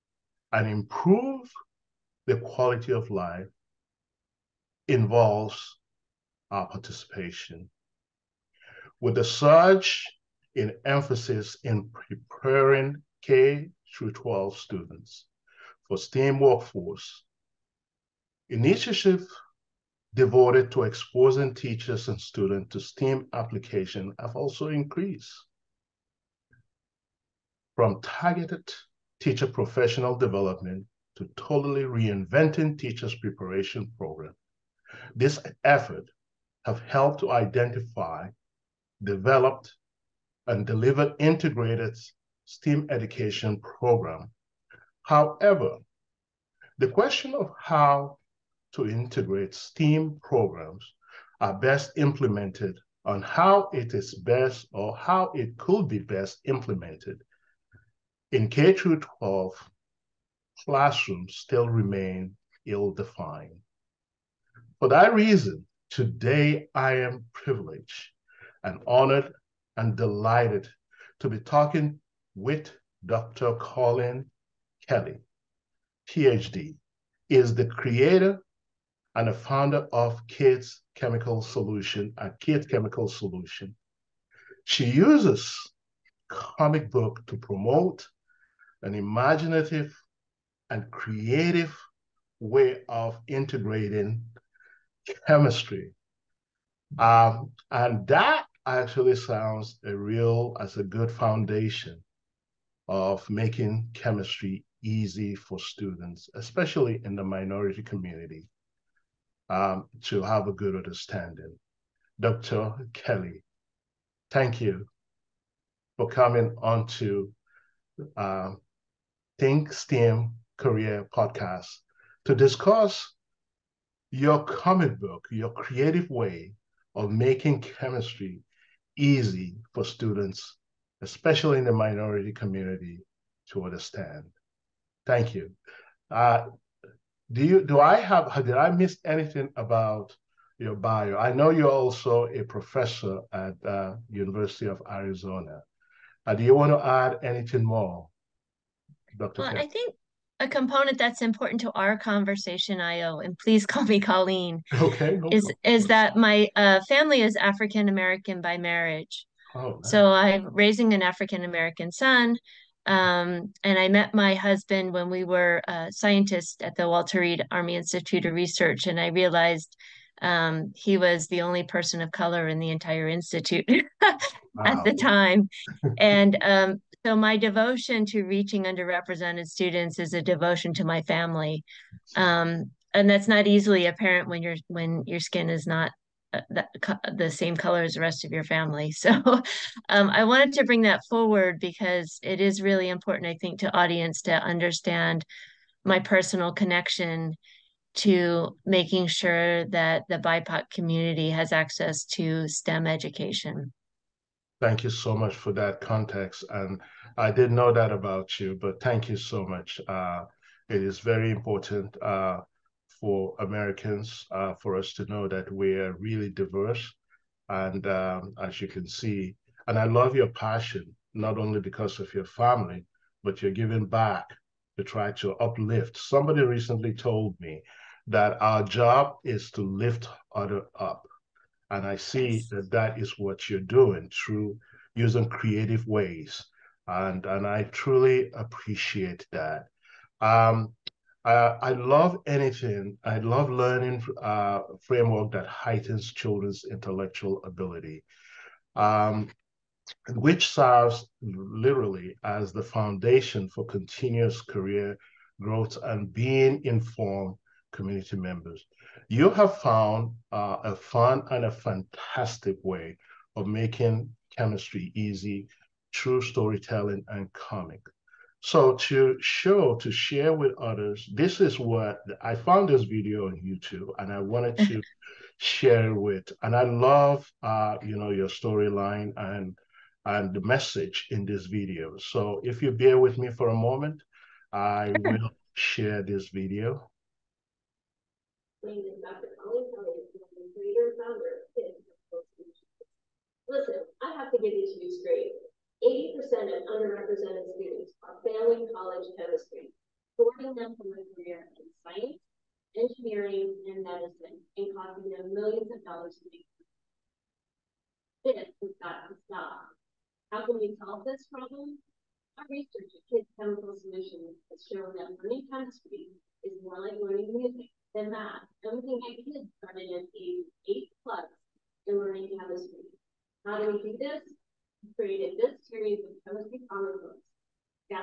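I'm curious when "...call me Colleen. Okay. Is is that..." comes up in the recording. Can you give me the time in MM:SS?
02:33.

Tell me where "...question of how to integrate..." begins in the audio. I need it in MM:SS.
00:46.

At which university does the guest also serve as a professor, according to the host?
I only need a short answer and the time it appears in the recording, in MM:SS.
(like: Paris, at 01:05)
University of Arizona, at 02:24.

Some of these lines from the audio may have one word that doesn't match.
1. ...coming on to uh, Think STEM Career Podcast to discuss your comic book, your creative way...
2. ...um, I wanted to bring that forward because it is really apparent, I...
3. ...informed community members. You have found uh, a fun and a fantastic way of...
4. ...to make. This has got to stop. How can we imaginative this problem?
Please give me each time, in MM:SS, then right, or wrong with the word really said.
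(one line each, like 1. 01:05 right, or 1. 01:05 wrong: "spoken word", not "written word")
1. 01:56 right
2. 03:09 wrong: "important", not "apparent"
3. 04:16 right
4. 05:06 wrong: "solve", not "imaginative".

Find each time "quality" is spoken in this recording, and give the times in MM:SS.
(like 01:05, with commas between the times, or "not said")
00:02.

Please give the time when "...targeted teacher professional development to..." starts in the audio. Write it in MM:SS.
00:28.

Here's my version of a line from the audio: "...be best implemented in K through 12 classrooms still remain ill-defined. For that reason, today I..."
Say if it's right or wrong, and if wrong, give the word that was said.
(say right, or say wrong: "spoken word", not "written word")
right.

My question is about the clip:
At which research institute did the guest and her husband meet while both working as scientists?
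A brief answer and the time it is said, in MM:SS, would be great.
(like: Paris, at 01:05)
Walter Reed Army Institute of Research, at 02:46.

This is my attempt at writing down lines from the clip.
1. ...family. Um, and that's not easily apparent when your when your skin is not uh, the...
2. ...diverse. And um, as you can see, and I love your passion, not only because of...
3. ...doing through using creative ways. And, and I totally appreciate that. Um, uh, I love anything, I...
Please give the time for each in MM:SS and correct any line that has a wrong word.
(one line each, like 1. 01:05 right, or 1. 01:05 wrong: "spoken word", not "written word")
1. 03:01 right
2. 03:36 right
3. 03:53 wrong: "truly", not "totally".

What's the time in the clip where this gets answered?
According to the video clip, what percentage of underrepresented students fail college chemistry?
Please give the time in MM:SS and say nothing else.
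04:55.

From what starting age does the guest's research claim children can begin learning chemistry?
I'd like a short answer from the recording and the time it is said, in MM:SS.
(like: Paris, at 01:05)
8, at 05:20.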